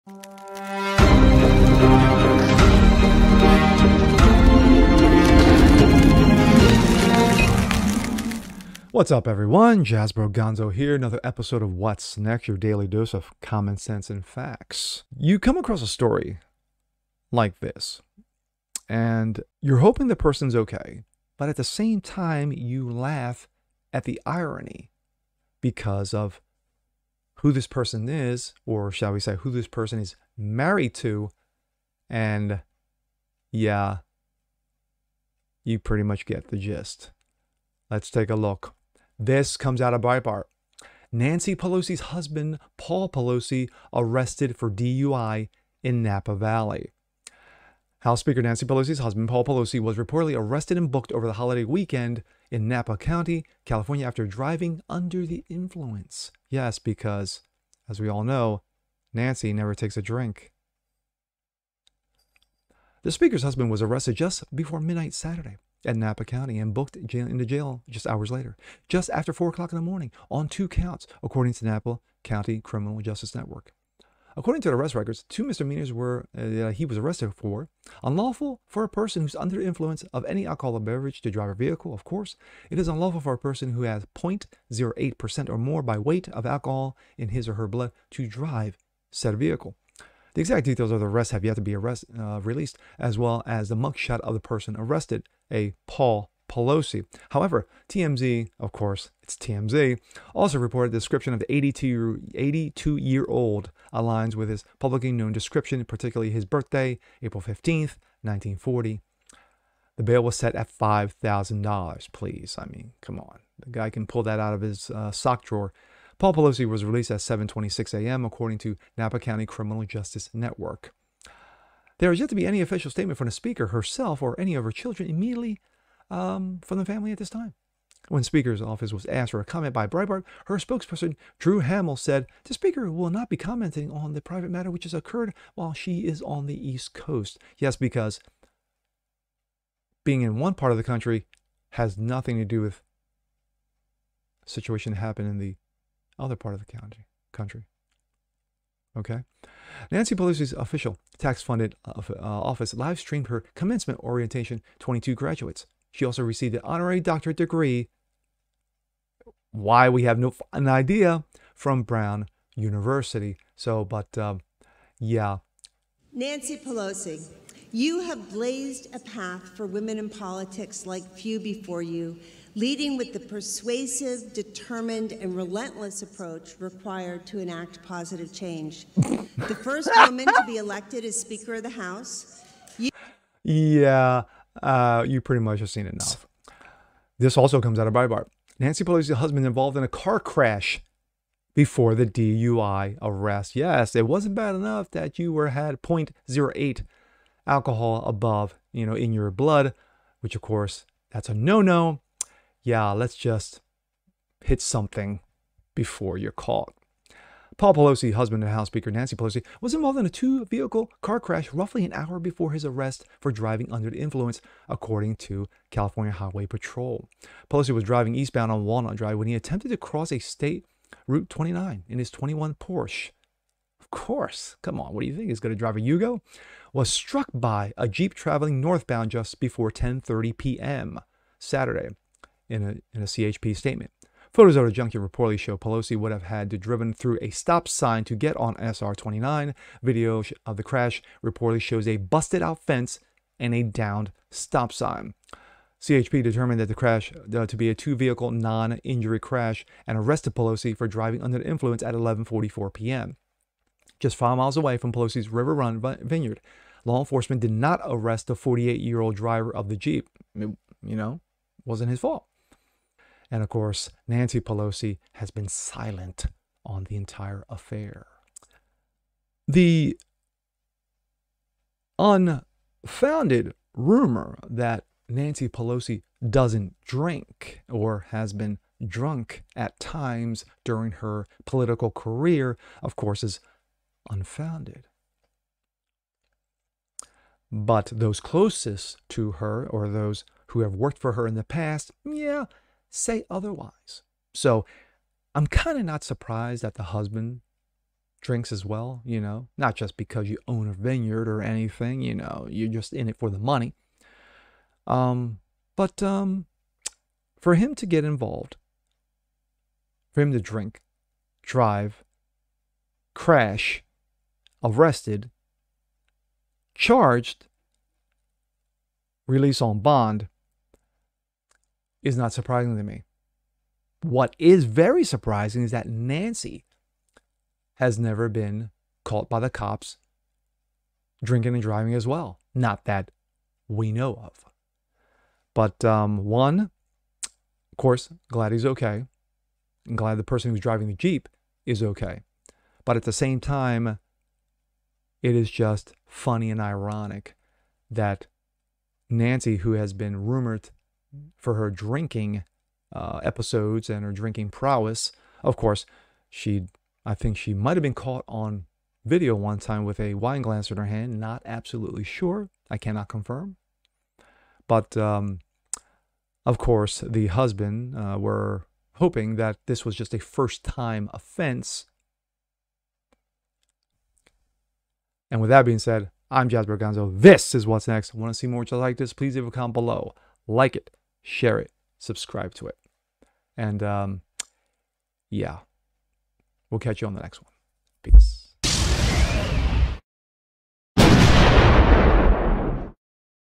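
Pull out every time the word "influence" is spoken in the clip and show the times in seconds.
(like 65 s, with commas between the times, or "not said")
55 s, 79 s, 213 s, 251 s.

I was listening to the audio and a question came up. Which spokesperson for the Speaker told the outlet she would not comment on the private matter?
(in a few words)
Drew Hamill.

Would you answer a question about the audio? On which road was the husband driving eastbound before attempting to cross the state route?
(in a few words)
Walnut Drive.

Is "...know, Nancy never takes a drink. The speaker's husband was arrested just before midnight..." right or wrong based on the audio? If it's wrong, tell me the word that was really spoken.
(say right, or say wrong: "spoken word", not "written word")
right.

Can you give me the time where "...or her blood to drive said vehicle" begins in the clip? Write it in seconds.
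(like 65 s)
87 s.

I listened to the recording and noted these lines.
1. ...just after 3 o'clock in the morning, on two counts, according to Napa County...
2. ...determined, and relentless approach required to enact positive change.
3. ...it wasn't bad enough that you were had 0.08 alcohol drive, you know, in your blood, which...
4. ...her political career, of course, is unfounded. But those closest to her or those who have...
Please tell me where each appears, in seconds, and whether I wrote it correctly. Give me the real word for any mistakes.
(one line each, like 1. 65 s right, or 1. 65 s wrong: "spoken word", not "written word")
1. 68 s wrong: "4", not "3"
2. 174 s right
3. 193 s wrong: "above", not "drive"
4. 280 s right.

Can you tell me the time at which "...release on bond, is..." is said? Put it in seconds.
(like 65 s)
319 s.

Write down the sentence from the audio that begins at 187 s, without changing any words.
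This also comes out of Breitbart.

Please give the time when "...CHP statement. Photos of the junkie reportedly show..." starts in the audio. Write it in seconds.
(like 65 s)
233 s.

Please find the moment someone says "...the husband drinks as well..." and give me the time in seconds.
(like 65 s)
296 s.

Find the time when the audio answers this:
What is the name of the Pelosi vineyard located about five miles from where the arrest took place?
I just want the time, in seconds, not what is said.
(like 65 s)
255 s.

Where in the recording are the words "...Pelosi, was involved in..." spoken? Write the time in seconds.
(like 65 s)
209 s.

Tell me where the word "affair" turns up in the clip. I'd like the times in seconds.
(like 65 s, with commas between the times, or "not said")
267 s.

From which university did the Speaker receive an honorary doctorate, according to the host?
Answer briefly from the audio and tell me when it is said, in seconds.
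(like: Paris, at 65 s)
Brown University, at 161 s.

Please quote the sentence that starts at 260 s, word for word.
It, you know, wasn't his fault.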